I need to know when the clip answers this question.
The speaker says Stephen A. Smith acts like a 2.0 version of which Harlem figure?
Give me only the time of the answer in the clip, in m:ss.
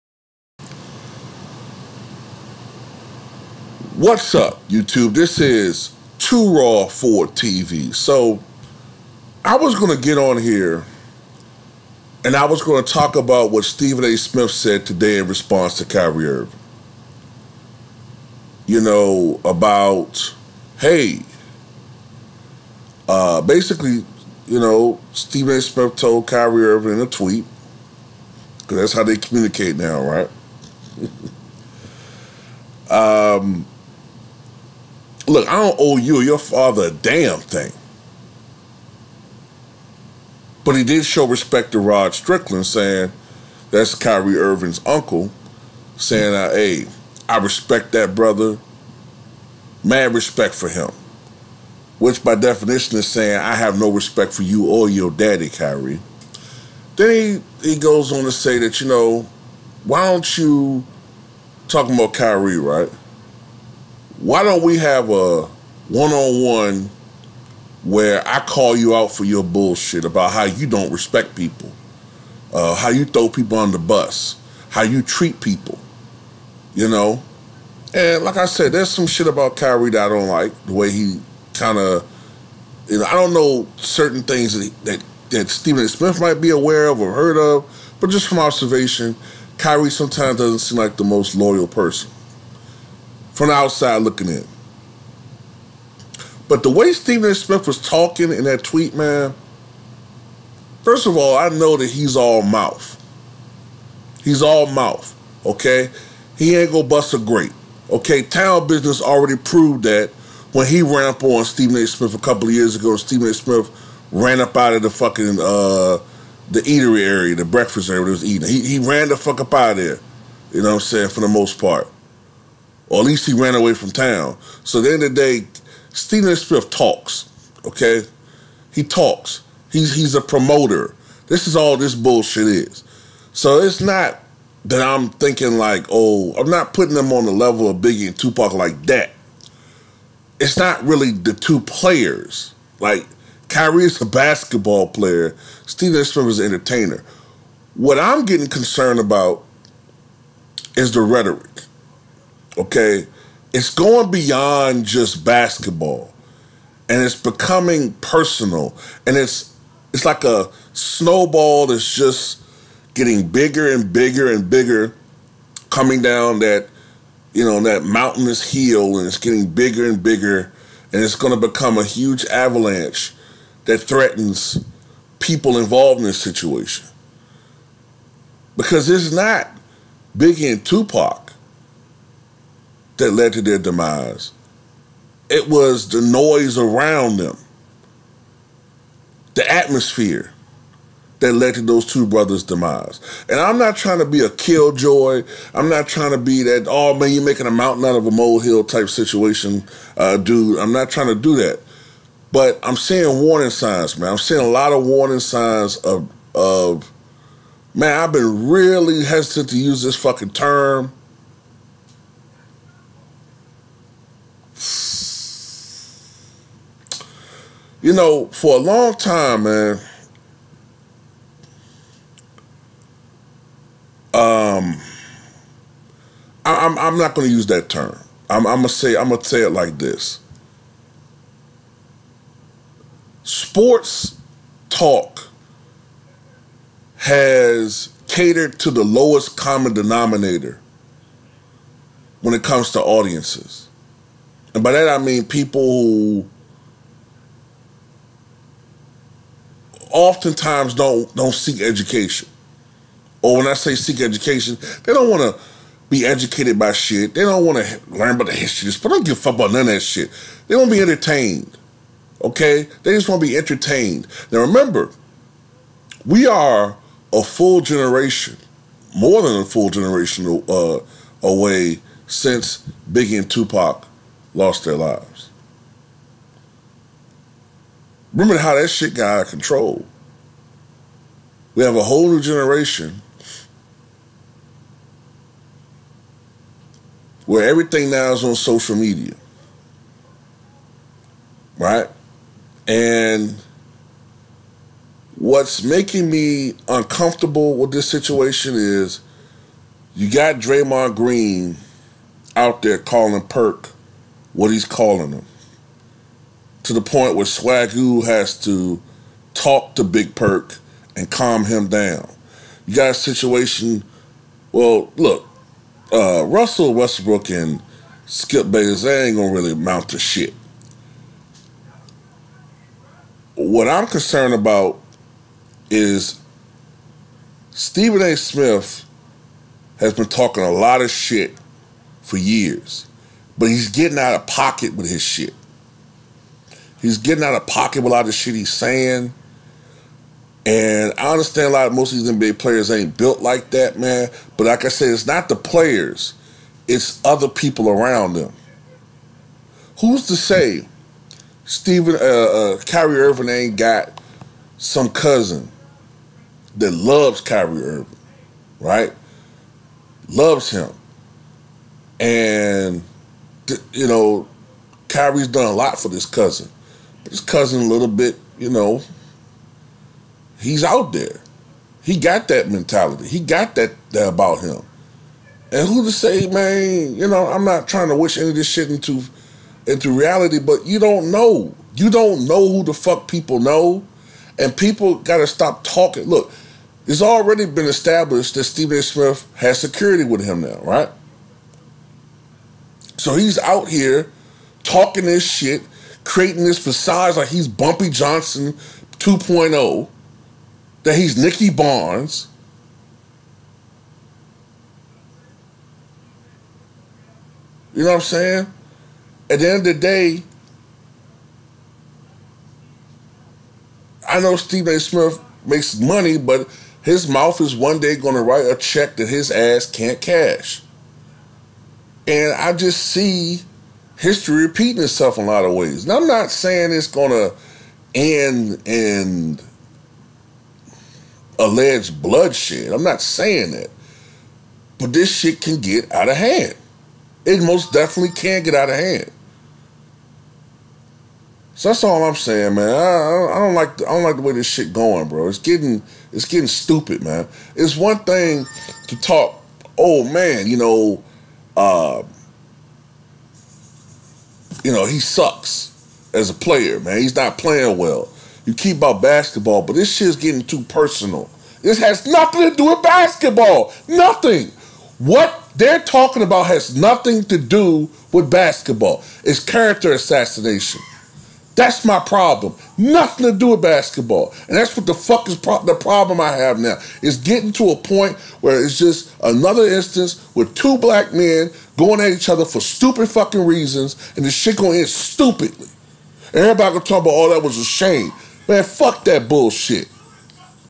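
6:37.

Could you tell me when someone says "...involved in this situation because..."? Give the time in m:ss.
2:55.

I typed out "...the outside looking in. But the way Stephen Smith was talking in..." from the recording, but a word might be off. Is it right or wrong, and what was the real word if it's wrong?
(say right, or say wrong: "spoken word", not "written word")
right.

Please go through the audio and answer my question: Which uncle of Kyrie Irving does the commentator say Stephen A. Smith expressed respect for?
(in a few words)
Rod Strickland.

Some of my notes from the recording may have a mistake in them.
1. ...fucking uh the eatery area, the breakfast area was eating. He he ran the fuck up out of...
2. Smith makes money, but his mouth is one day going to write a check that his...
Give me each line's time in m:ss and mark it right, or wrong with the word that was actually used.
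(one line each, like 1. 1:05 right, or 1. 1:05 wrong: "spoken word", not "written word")
1. 1:54 right
2. 6:54 right.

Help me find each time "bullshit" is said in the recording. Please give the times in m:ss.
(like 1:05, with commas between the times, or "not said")
1:09, 2:11, 8:09.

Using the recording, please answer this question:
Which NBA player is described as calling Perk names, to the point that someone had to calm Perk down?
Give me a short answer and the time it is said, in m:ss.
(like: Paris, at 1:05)
Draymond Green, at 5:00.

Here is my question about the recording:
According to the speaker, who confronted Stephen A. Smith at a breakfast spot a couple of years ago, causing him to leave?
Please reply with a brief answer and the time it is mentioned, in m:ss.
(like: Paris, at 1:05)
Town Business, at 1:48.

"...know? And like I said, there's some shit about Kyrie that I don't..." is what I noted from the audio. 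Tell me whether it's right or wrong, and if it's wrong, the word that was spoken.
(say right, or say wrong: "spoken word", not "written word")
right.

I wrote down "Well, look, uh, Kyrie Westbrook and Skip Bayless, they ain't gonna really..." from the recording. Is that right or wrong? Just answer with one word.
wrong.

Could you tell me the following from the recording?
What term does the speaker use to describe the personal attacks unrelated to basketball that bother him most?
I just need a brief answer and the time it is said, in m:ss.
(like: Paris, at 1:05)
Character assassination, at 7:49.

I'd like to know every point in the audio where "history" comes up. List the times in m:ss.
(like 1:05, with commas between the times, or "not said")
4:18, 7:03.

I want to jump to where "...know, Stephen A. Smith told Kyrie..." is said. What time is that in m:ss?
0:24.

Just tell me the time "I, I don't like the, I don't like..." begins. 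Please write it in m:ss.
7:22.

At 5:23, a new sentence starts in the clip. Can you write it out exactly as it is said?
What I'm concerned about is Stephen A.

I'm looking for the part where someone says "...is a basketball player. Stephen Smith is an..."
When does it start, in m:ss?
2:23.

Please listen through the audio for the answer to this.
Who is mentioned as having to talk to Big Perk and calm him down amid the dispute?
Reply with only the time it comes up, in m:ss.
5:07.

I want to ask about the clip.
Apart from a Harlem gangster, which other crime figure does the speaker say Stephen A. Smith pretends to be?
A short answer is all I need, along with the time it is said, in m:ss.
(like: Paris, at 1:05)
Nicky Barnes, at 6:41.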